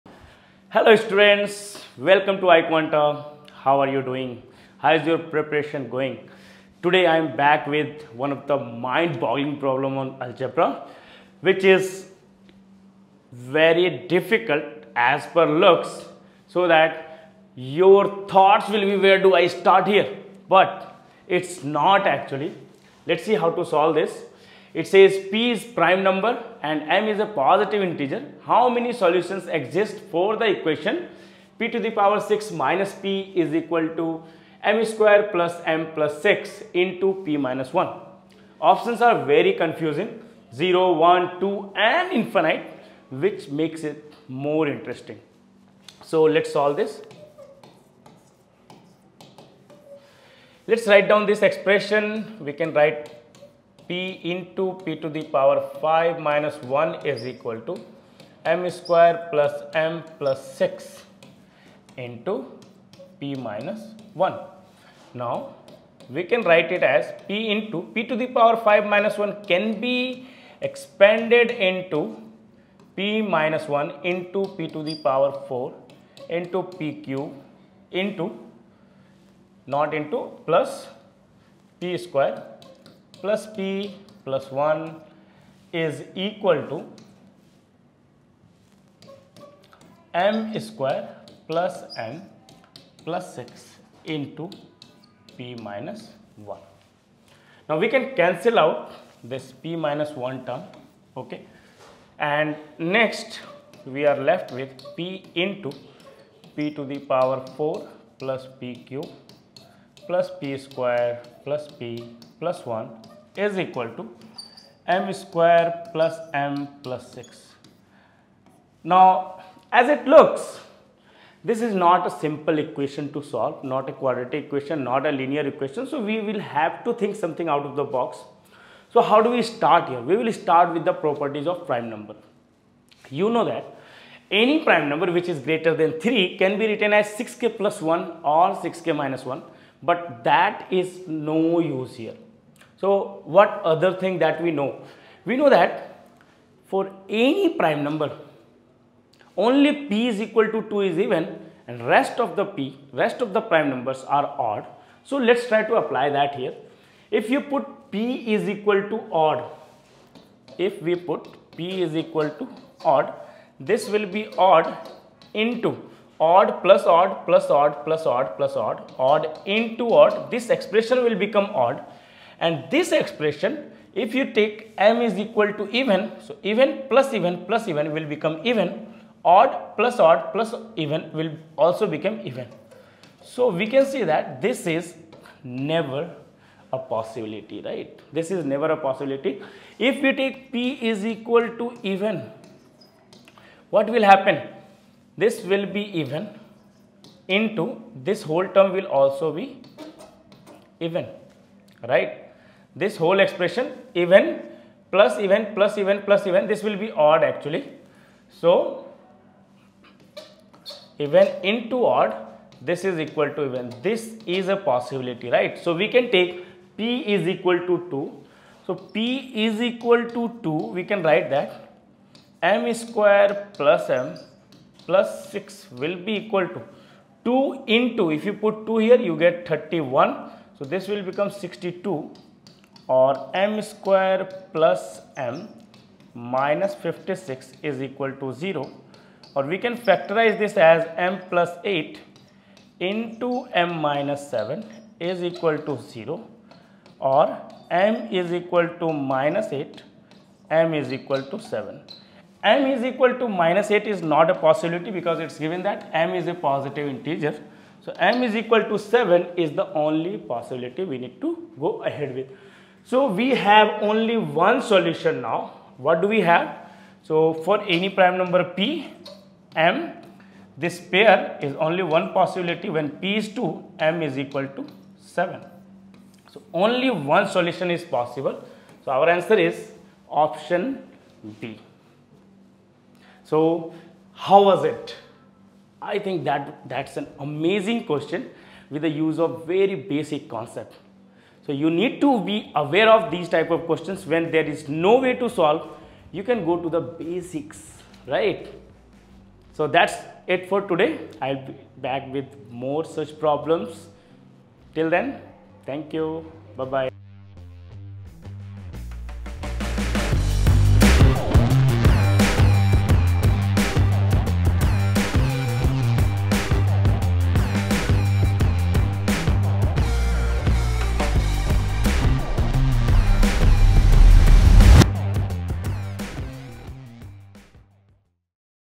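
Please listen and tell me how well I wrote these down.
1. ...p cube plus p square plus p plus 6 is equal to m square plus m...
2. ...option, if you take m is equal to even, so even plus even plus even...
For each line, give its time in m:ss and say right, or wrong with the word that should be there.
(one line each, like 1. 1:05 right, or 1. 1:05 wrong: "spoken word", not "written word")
1. 1:48 wrong: "1", not "6"
2. 2:52 wrong: "expression", not "option".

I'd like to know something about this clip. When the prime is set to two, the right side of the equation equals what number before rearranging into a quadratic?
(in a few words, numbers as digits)
62.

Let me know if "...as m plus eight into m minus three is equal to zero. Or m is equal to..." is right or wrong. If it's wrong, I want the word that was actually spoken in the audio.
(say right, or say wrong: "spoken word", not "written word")
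wrong: "seven", not "three".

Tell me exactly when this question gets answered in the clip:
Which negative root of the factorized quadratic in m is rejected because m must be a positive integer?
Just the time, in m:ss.
4:13.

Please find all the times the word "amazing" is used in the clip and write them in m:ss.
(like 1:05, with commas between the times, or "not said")
4:47.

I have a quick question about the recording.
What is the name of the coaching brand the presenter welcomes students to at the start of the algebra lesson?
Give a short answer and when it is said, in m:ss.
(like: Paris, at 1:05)
iQuanta, at 0:02.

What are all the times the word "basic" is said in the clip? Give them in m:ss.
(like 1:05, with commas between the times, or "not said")
4:49, 4:56.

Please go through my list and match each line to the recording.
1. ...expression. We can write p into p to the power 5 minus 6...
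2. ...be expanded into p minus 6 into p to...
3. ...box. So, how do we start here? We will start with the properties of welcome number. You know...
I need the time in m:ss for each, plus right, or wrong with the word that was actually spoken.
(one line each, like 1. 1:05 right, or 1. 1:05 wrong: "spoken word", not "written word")
1. 0:51 wrong: "1", not "6"
2. 1:09 wrong: "1", not "6"
3. 2:07 wrong: "prime", not "welcome".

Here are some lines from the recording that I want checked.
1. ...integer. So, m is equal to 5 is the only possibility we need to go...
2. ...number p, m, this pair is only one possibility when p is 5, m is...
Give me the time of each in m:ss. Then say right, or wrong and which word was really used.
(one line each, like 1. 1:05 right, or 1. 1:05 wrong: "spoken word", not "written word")
1. 4:16 wrong: "7", not "5"
2. 4:28 wrong: "2", not "5".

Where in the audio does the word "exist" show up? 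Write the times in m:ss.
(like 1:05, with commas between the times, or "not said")
0:29.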